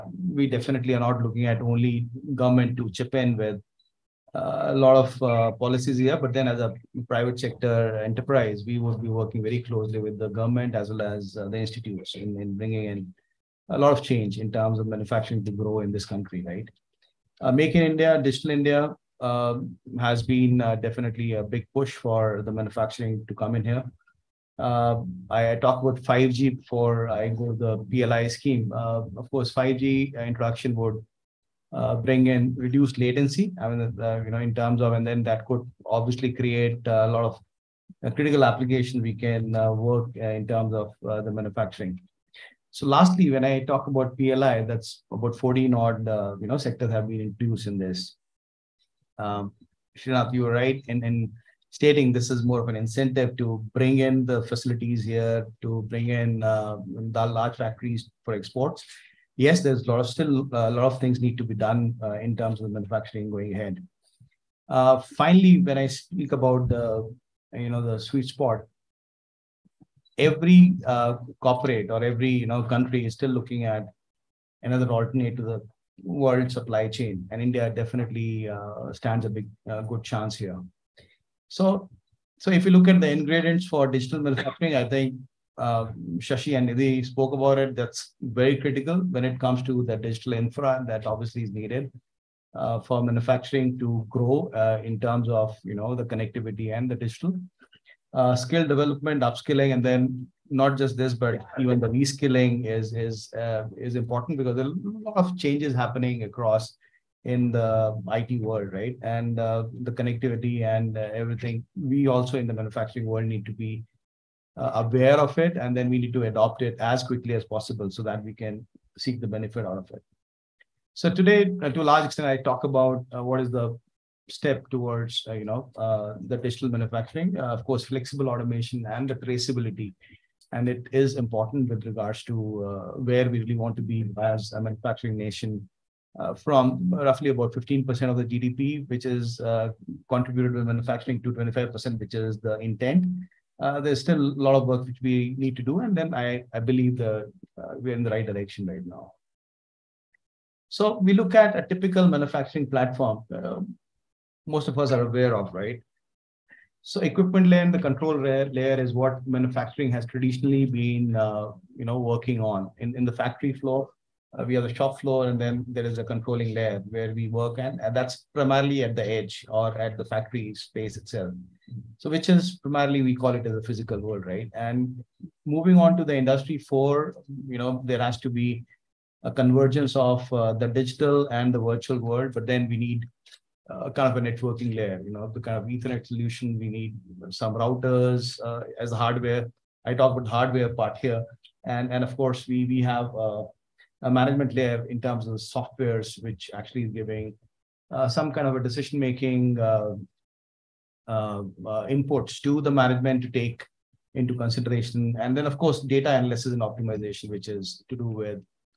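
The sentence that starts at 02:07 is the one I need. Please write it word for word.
of course, flexible automation and the traceability.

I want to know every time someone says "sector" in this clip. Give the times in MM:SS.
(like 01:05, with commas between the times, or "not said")
00:07, 00:46.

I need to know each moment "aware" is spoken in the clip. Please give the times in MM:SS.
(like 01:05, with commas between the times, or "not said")
01:54, 02:35.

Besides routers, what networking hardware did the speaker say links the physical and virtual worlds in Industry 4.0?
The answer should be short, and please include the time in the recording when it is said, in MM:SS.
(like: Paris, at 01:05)
Ethernet, at 03:05.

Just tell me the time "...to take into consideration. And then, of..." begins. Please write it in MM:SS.
03:23.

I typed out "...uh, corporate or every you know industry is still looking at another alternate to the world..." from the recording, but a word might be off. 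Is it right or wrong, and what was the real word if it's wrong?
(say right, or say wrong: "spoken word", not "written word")
wrong: "country", not "industry".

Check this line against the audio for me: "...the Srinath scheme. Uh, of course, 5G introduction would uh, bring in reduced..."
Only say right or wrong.
wrong.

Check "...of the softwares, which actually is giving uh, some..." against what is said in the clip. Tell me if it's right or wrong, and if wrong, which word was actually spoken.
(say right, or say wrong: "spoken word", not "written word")
right.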